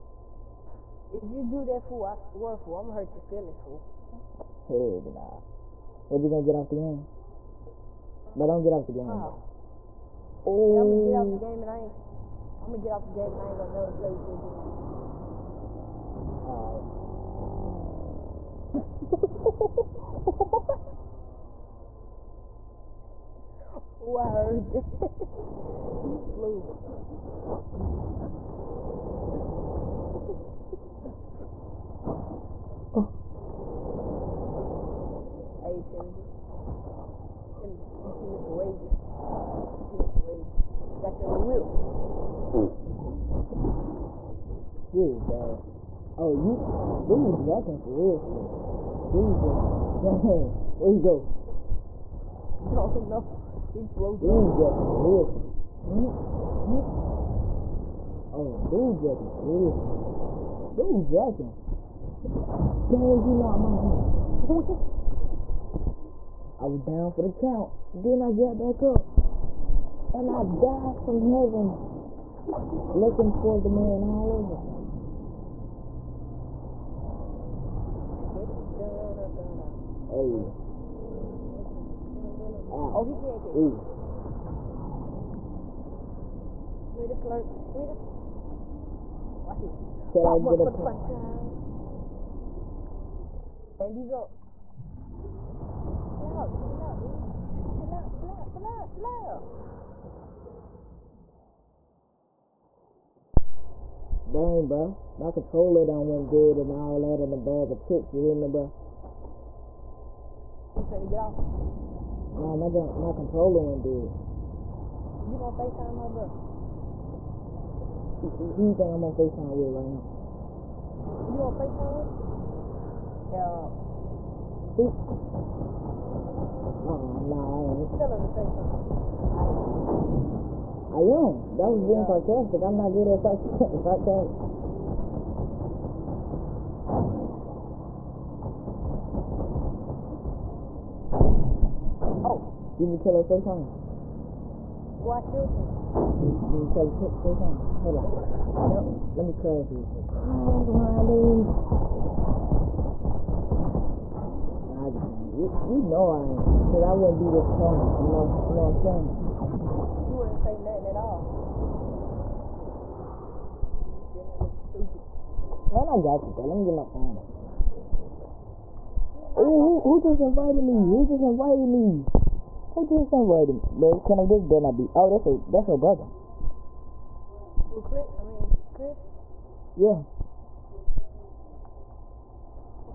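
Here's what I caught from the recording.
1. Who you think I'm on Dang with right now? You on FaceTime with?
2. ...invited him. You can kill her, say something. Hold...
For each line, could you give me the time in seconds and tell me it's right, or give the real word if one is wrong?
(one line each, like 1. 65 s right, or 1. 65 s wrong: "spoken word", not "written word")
1. 118 s wrong: "FaceTime", not "Dang"
2. 145 s wrong: "killed", not "invited".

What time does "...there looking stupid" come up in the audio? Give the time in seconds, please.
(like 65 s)
164 s.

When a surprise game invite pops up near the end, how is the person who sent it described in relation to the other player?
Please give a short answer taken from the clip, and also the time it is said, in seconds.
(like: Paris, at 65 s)
brother, at 175 s.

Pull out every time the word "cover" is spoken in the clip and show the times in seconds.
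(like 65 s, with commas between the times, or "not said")
not said.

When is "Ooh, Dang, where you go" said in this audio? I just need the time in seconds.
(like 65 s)
49 s.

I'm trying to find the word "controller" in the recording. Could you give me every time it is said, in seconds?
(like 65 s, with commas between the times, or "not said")
105 s, 113 s.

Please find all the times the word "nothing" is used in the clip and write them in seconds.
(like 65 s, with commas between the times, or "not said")
160 s.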